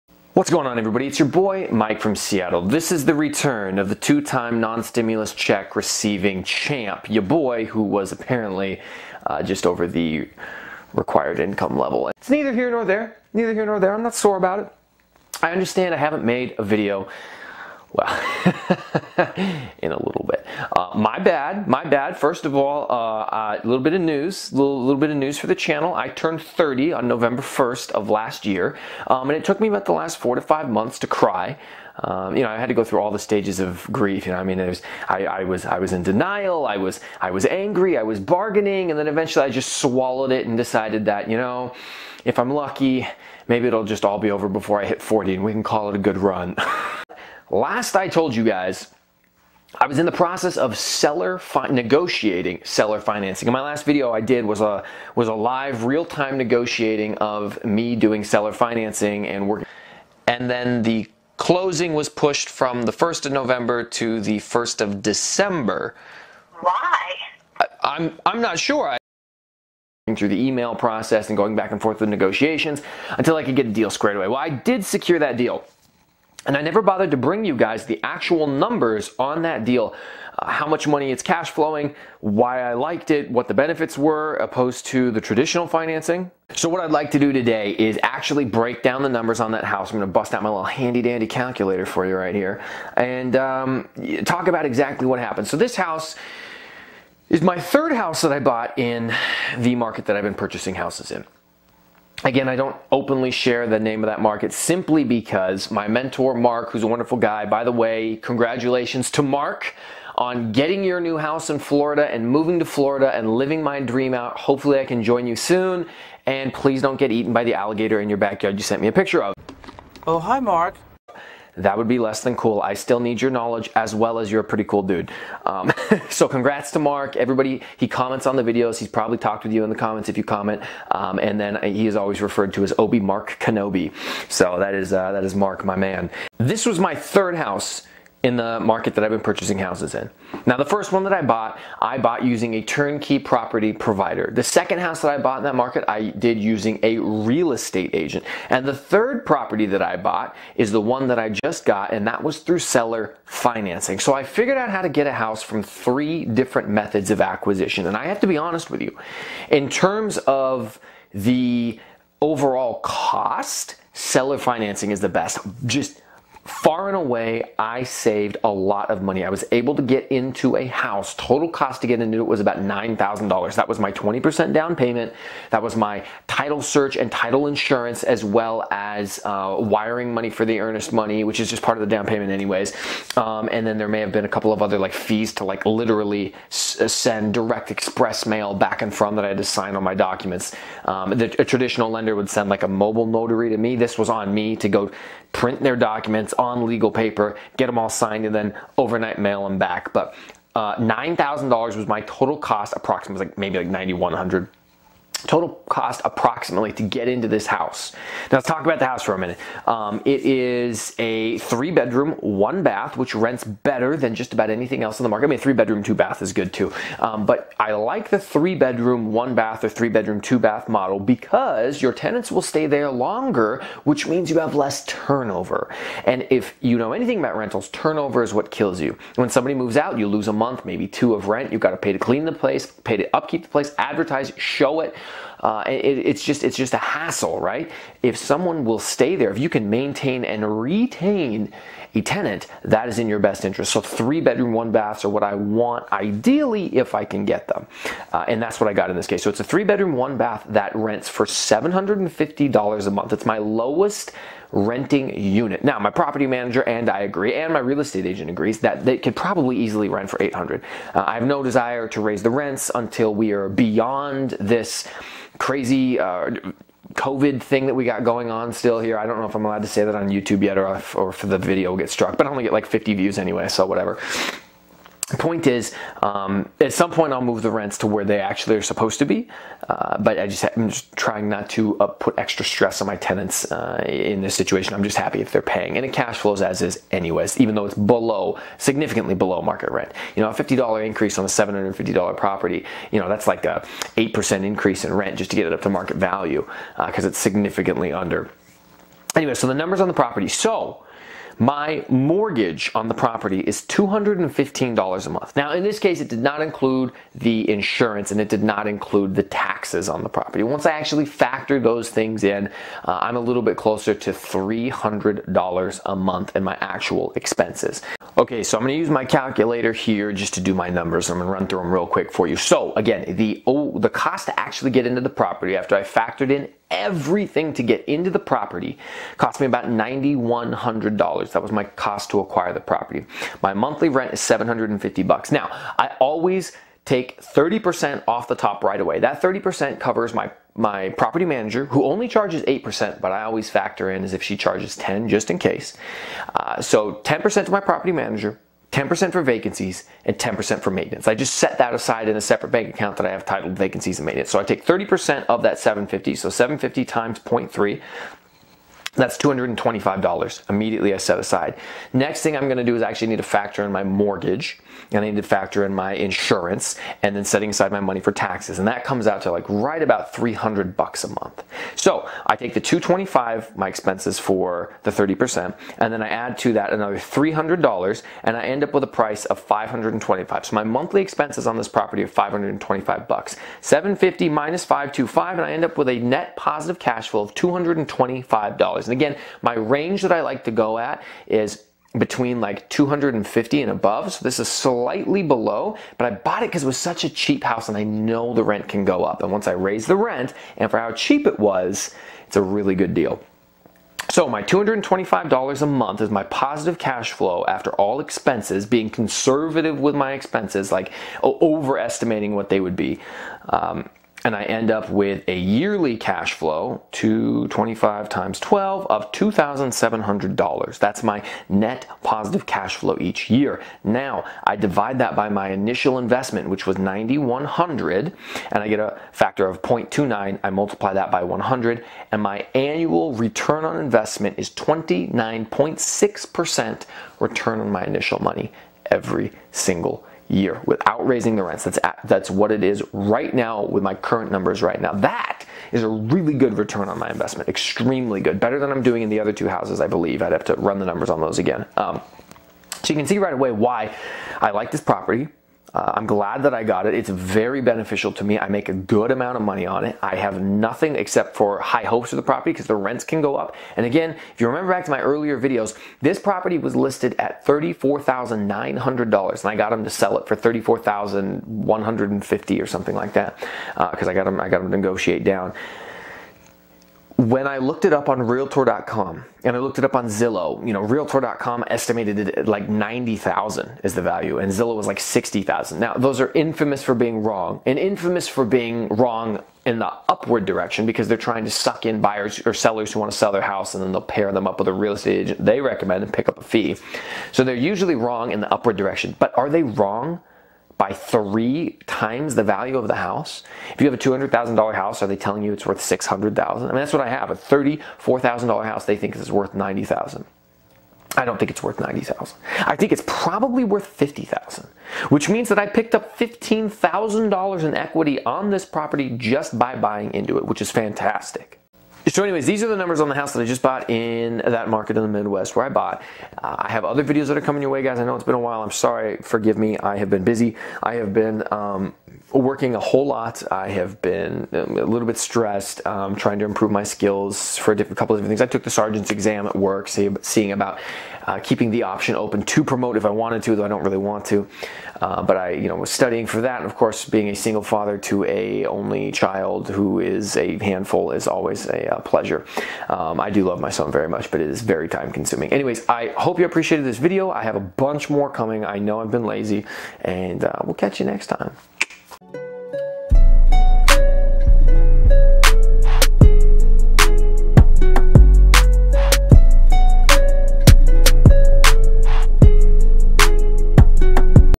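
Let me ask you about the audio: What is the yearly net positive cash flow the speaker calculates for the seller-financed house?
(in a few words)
$2,700.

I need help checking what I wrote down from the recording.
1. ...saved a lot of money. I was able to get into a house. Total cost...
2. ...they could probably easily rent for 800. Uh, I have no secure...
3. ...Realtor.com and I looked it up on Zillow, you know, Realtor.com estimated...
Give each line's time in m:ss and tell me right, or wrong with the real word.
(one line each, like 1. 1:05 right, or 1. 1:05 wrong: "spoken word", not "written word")
1. 2:47 right
2. 4:18 wrong: "desire", not "secure"
3. 7:58 right.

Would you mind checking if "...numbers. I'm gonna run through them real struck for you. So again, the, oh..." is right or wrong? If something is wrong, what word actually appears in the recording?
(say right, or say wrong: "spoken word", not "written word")
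wrong: "quick", not "struck".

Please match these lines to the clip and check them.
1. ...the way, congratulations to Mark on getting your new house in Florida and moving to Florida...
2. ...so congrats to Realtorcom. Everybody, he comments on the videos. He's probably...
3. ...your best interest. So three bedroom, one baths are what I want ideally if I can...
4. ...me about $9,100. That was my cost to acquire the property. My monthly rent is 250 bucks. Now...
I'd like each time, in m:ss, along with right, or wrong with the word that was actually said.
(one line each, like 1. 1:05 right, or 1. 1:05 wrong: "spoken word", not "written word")
1. 1:47 right
2. 2:06 wrong: "Mark", not "Realtorcom"
3. 4:03 right
4. 5:29 wrong: "750", not "250".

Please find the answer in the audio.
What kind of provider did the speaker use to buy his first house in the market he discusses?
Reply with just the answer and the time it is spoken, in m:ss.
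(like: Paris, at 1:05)
turnkey property provider, at 2:22.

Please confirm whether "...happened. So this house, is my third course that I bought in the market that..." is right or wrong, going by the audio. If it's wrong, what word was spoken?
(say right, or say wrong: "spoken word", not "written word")
wrong: "house", not "course".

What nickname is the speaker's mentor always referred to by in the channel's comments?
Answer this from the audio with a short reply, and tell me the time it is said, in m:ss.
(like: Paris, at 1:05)
Obi Mark Kenobi, at 2:12.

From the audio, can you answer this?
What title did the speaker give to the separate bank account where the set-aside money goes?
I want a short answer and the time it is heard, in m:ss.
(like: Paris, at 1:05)
vacancies and maintenance, at 5:53.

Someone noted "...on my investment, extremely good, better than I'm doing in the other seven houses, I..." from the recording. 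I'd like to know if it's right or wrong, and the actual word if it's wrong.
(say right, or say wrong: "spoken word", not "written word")
wrong: "two", not "seven".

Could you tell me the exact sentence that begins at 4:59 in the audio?
Anyway, so the numbers on the property.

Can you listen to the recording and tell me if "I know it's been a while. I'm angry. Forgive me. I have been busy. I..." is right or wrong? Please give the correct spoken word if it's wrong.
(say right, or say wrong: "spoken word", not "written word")
wrong: "sorry", not "angry".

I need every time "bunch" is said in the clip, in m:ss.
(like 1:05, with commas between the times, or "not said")
9:17.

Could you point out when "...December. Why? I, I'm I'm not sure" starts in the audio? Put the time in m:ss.
1:05.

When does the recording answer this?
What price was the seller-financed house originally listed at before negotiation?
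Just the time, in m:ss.
7:47.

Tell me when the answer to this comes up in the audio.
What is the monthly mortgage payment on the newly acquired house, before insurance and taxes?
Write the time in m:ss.
5:03.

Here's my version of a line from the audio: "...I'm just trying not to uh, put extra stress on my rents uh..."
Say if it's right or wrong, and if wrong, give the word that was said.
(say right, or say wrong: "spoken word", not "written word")
wrong: "tenants", not "rents".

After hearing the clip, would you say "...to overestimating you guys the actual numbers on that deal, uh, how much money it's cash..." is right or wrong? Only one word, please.
wrong.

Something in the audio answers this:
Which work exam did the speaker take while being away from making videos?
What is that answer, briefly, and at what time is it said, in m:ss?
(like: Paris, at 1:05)
sergeant's exam, at 8:58.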